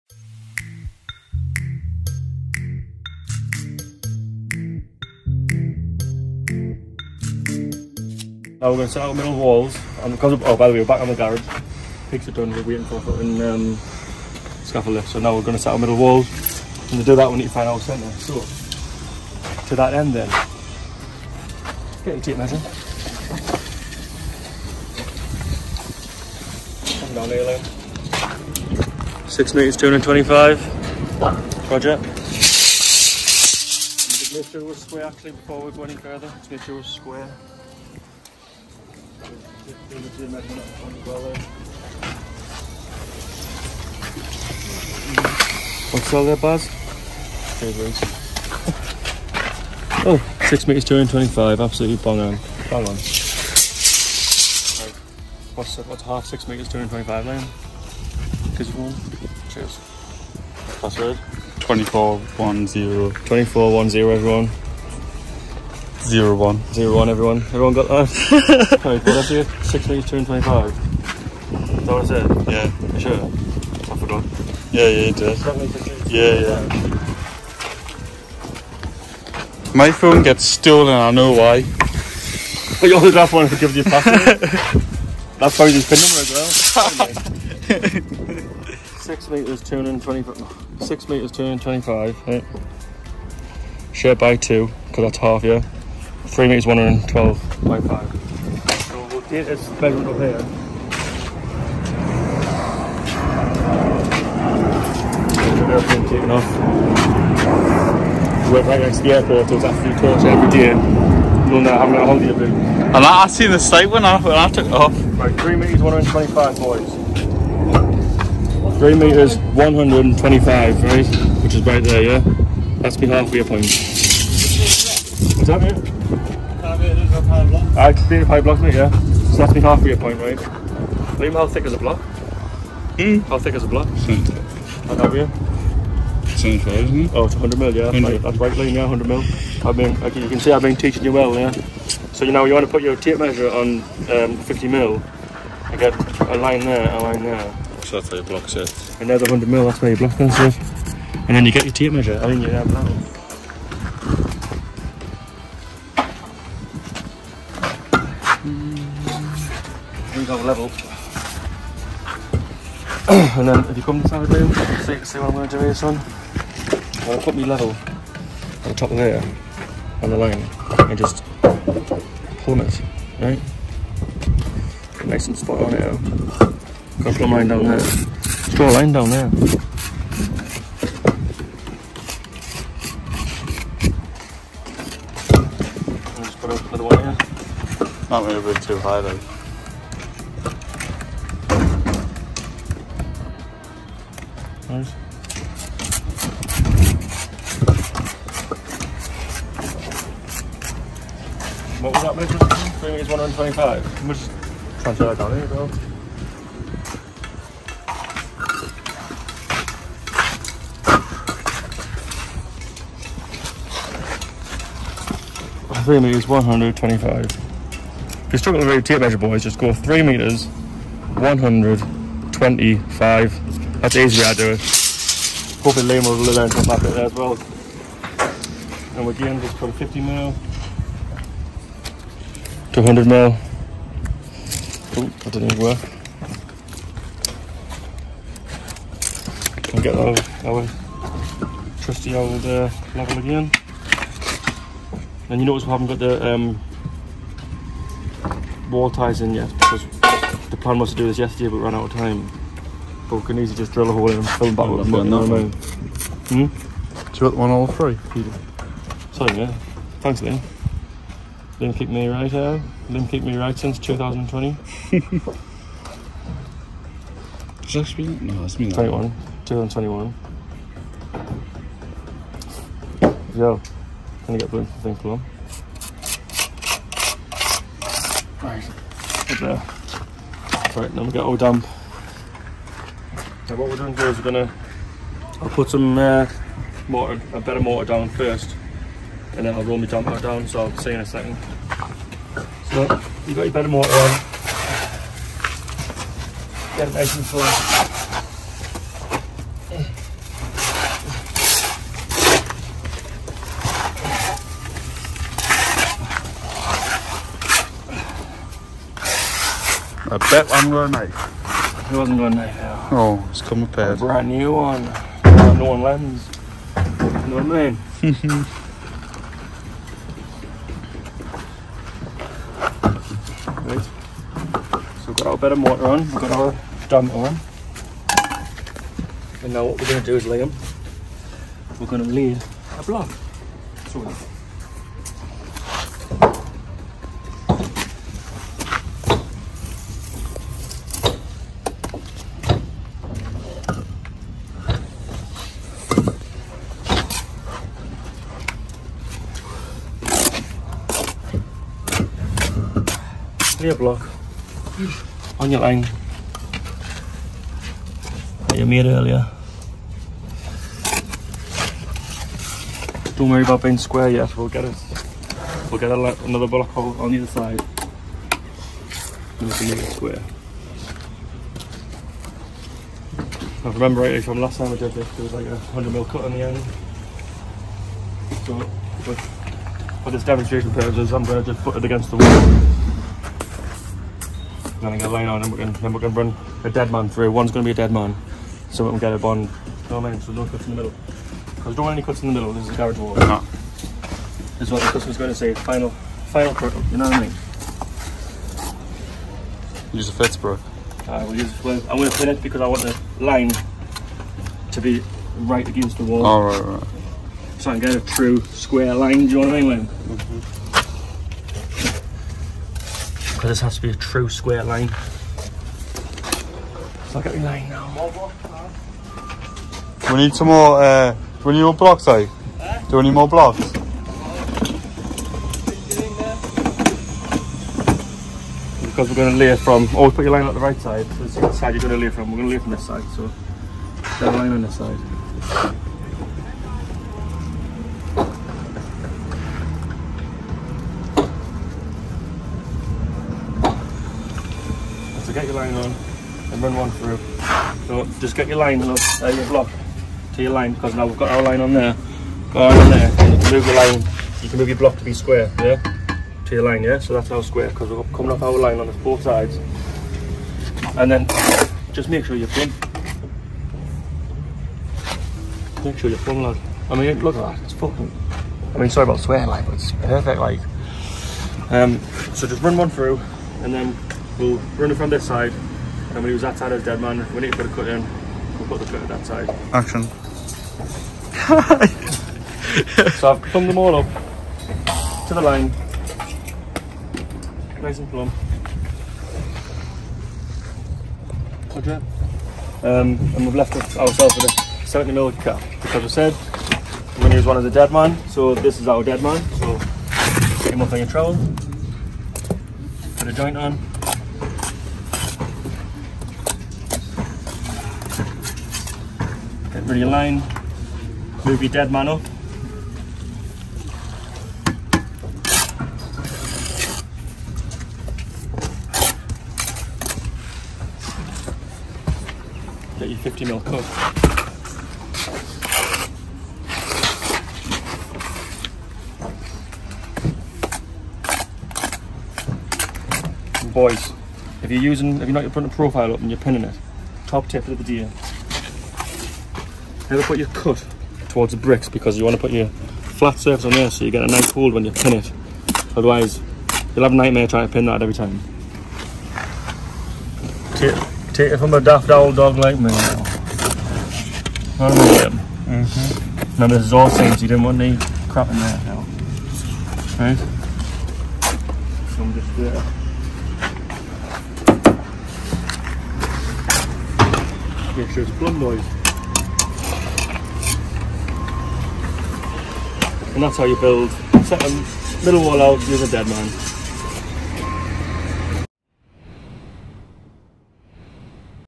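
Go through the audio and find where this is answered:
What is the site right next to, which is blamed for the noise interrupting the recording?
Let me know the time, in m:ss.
1:49.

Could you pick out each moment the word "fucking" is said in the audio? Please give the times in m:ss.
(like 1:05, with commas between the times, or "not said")
0:13, 7:47.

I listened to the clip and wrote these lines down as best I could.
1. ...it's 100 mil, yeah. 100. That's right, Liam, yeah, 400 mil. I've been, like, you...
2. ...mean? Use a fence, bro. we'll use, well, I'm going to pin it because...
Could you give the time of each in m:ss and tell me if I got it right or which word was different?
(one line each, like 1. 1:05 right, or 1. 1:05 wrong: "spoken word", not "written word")
1. 2:17 wrong: "100", not "400"
2. 6:37 right.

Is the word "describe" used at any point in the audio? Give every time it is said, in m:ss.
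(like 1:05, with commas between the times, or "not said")
not said.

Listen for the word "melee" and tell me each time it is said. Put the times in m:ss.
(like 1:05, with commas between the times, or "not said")
not said.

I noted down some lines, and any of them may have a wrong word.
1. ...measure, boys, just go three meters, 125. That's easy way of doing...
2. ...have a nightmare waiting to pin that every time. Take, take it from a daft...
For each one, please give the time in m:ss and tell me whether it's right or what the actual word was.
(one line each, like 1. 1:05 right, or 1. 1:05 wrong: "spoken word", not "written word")
1. 3:39 right
2. 9:07 wrong: "trying", not "waiting".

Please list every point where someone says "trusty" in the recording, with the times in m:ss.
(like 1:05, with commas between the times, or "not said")
4:01.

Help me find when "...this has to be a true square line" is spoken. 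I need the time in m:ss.
6:53.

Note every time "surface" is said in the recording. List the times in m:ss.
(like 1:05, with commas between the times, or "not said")
9:03.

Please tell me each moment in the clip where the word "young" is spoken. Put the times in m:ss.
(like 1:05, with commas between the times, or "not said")
not said.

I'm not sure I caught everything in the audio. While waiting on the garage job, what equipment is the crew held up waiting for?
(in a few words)
scaffold lift.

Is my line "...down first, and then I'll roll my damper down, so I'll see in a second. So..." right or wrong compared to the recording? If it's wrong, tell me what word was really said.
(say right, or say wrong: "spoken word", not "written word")
right.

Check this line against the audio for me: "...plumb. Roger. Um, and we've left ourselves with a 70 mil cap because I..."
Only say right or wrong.
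right.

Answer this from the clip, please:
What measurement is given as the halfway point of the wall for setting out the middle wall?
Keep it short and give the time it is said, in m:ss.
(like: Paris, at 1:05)
3 metres 125, at 1:36.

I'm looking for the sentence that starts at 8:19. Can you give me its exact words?
So take him up on your trowel, put a joint on, over the line, move your dead man up.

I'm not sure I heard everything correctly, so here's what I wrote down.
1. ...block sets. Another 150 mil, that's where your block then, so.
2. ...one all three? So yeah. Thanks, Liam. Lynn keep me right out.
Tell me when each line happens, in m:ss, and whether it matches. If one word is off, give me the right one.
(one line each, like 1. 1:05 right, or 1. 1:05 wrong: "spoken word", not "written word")
1. 2:28 wrong: "100", not "150"
2. 4:17 wrong: "Lynn", not "Liam".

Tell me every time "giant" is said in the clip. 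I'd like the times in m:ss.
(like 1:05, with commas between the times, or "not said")
not said.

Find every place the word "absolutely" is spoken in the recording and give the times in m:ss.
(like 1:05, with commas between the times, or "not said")
0:51, 1:49.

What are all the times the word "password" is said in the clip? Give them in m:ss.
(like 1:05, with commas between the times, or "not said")
1:00, 1:23.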